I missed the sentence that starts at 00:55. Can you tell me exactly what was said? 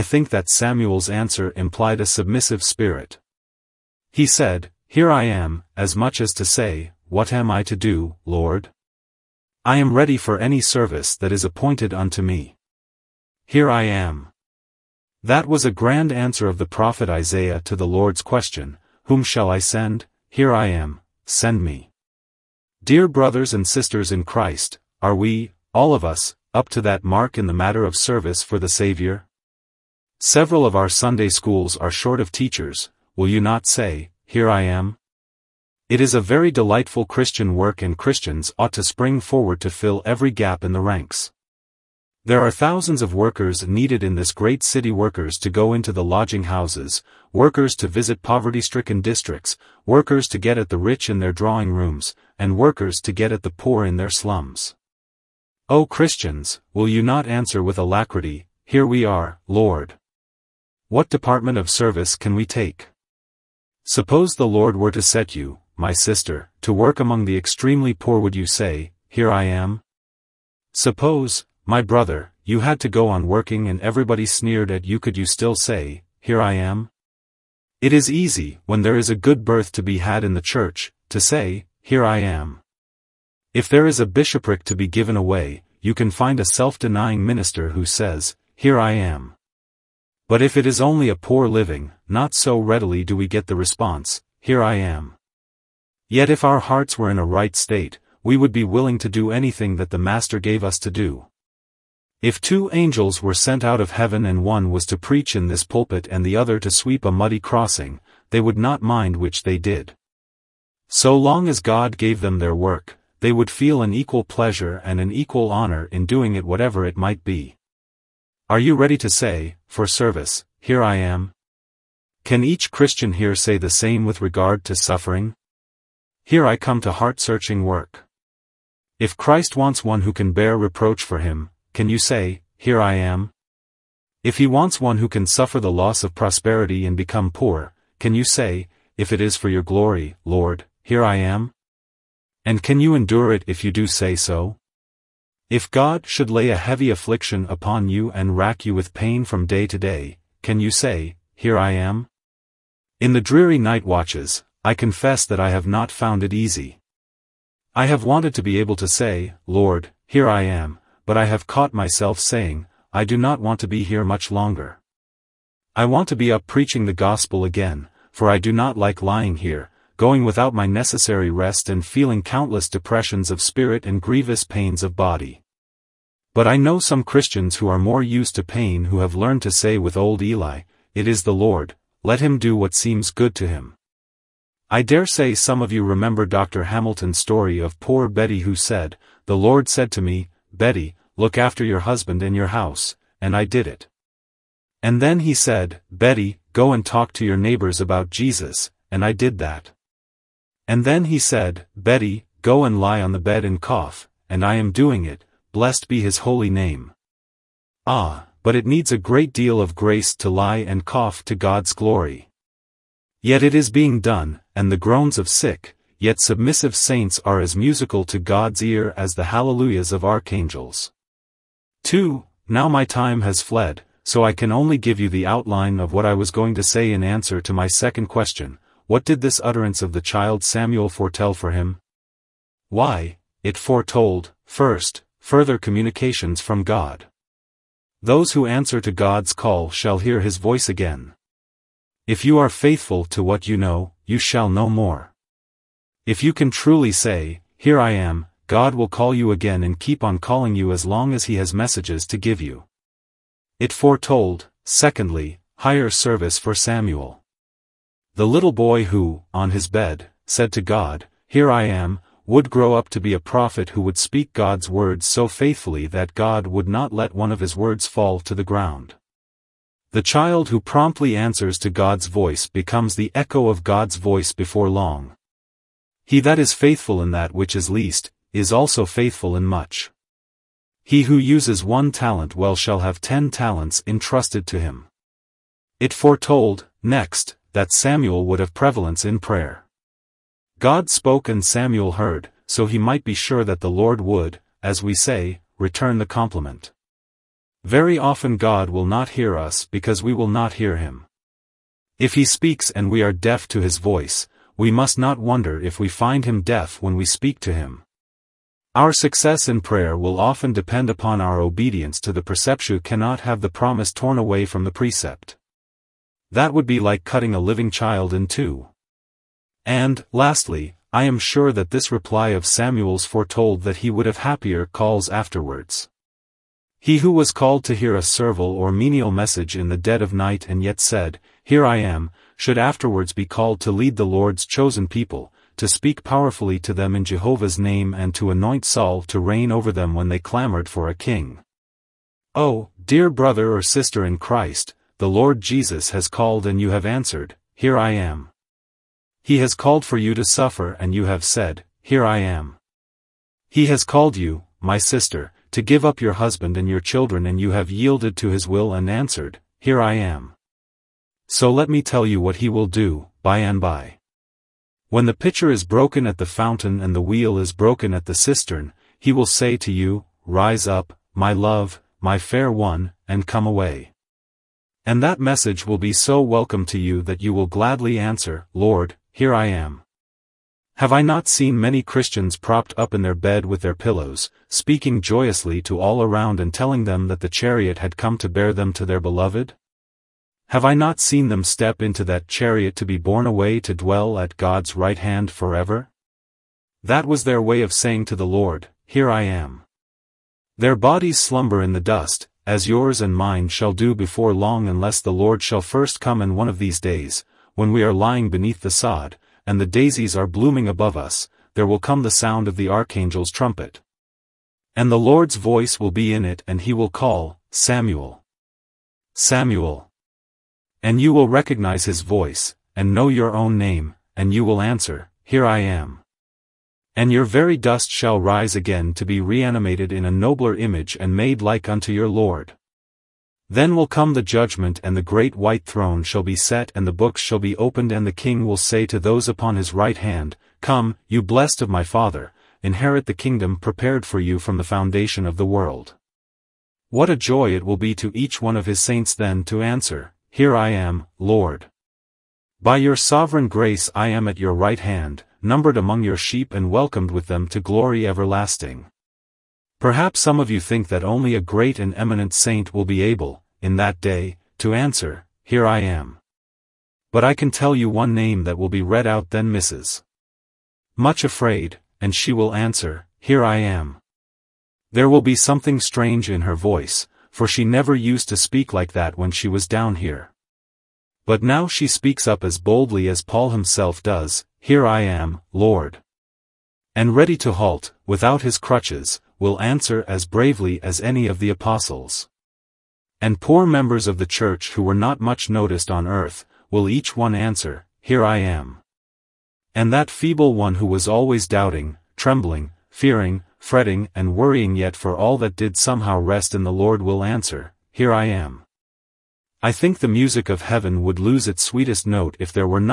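O Christians, will you not answer with alacrity, Here we are, Lord.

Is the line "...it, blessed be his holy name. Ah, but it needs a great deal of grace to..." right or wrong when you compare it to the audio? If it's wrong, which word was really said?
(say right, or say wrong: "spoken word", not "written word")
right.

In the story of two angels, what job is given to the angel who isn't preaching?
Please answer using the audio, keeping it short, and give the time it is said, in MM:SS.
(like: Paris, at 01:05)
Sweep a muddy crossing, at 01:46.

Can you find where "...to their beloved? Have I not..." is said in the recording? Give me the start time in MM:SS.
06:28.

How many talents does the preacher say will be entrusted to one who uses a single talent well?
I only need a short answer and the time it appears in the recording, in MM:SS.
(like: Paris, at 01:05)
10, at 04:43.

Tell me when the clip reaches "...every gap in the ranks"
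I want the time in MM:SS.
00:40.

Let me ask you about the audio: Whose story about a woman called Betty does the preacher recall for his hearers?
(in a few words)
Dr. Hamilton.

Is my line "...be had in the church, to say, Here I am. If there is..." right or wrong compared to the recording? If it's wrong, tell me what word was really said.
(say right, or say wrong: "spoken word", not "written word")
right.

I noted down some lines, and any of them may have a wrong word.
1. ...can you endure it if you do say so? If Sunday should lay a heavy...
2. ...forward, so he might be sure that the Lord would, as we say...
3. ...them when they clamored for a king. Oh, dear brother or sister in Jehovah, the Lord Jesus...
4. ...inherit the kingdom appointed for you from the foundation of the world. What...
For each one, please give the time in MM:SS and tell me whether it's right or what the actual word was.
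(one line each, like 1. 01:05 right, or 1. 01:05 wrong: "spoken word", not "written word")
1. 02:22 wrong: "God", not "Sunday"
2. 04:51 wrong: "heard", not "forward"
3. 05:39 wrong: "Christ", not "Jehovah"
4. 07:22 wrong: "prepared", not "appointed".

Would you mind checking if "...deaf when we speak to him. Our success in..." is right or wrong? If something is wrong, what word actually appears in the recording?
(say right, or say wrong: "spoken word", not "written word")
right.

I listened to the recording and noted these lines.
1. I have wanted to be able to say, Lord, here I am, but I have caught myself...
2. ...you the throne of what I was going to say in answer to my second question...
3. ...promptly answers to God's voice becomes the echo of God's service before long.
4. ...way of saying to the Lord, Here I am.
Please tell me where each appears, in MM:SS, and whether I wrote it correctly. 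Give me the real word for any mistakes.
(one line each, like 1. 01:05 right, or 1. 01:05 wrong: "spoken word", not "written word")
1. 02:37 right
2. 03:44 wrong: "outline", not "throne"
3. 04:30 wrong: "voice", not "service"
4. 06:37 right.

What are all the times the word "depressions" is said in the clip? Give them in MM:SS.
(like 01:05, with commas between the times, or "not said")
02:52.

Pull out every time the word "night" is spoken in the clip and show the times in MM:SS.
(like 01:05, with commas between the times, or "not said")
02:33, 05:30.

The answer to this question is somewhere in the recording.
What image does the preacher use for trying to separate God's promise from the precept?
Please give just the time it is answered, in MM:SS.
05:17.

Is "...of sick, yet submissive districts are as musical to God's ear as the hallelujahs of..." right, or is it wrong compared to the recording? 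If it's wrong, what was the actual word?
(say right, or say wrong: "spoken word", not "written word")
wrong: "saints", not "districts".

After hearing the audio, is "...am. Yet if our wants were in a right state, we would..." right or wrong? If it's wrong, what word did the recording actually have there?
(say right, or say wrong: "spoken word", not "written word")
wrong: "hearts", not "wants".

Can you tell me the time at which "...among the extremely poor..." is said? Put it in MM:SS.
01:06.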